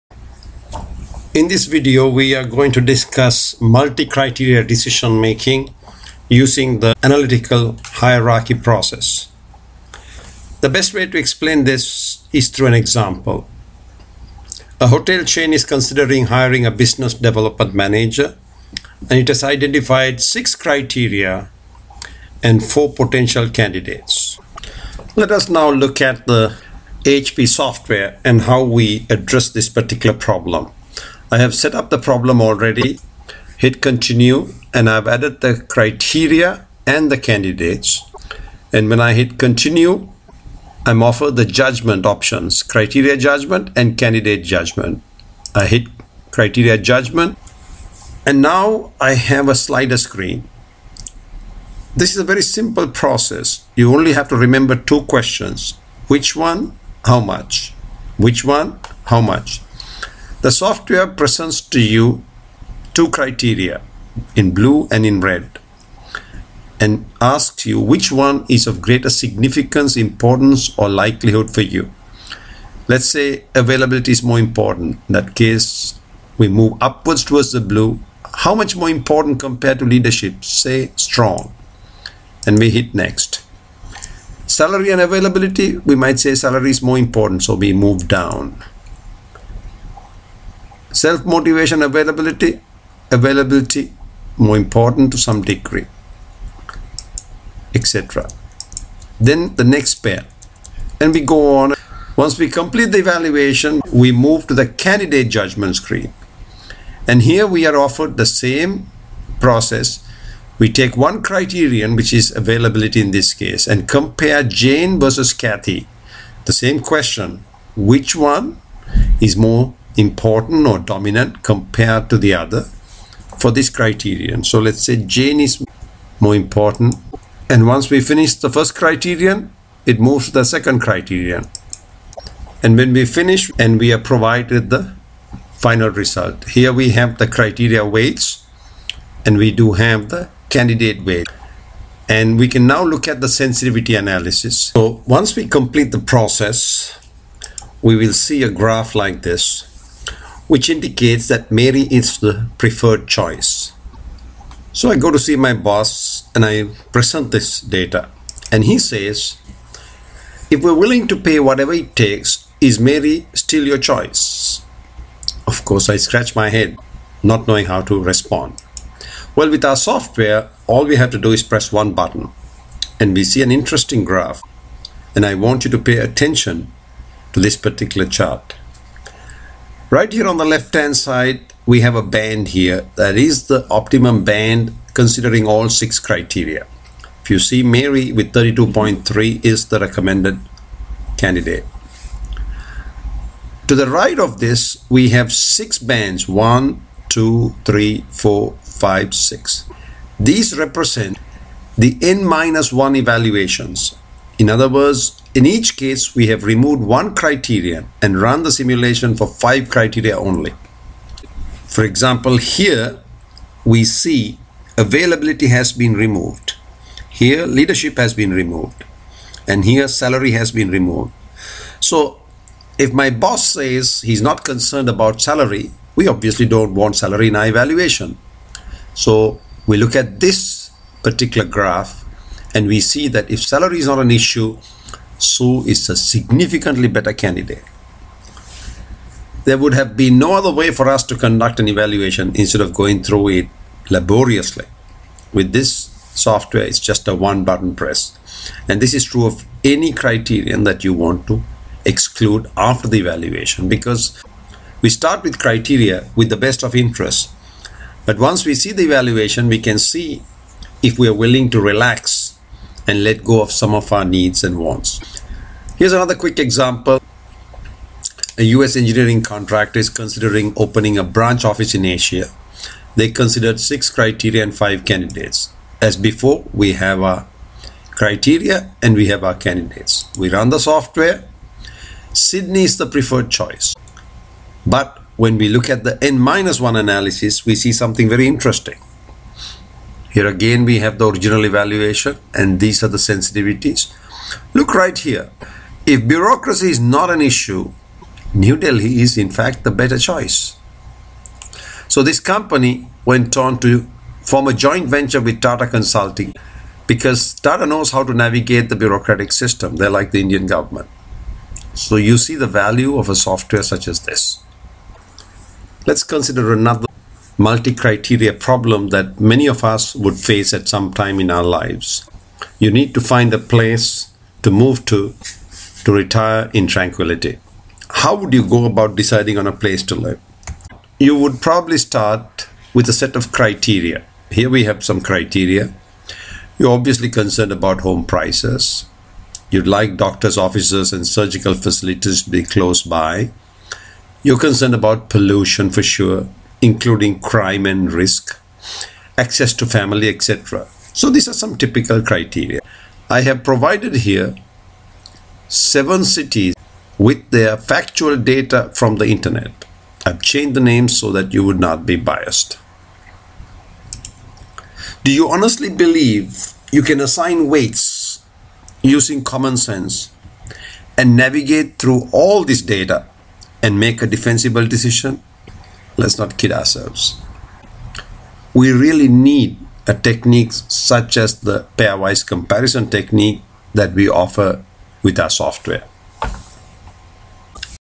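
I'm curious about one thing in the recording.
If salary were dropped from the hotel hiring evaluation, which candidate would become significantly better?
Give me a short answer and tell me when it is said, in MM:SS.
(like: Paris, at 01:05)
Sue, at 03:55.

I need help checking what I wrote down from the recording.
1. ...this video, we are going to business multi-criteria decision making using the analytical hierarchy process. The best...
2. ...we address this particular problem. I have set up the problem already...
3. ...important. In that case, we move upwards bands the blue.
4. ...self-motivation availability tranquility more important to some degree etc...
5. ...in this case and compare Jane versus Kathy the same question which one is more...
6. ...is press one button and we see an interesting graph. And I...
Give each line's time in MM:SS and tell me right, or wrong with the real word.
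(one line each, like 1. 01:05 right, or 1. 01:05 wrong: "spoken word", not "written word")
1. 00:01 wrong: "discuss", not "business"
2. 00:28 right
3. 01:14 wrong: "towards", not "bands"
4. 01:30 wrong: "availability", not "tranquility"
5. 01:53 right
6. 02:51 right.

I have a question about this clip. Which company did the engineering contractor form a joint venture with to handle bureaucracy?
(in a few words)
Tata Consulting.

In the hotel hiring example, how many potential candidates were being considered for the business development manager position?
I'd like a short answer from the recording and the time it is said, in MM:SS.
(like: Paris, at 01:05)
4, at 00:22.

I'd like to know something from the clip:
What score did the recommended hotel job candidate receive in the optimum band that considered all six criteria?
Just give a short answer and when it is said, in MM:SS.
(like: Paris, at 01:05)
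32.3, at 03:08.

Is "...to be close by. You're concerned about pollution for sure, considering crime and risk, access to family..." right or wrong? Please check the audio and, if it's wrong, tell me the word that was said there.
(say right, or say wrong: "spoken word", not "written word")
wrong: "including", not "considering".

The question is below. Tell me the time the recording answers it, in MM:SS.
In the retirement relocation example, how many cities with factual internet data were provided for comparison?
05:55.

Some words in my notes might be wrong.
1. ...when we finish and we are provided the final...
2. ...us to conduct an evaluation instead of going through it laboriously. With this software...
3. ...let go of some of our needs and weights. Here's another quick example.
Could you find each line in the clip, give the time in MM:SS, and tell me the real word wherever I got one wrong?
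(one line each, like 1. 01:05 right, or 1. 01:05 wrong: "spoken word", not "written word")
1. 02:12 right
2. 04:00 right
3. 04:23 wrong: "wants", not "weights".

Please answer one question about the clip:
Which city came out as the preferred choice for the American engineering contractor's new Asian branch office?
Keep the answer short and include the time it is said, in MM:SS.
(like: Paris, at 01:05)
Sydney, at 04:42.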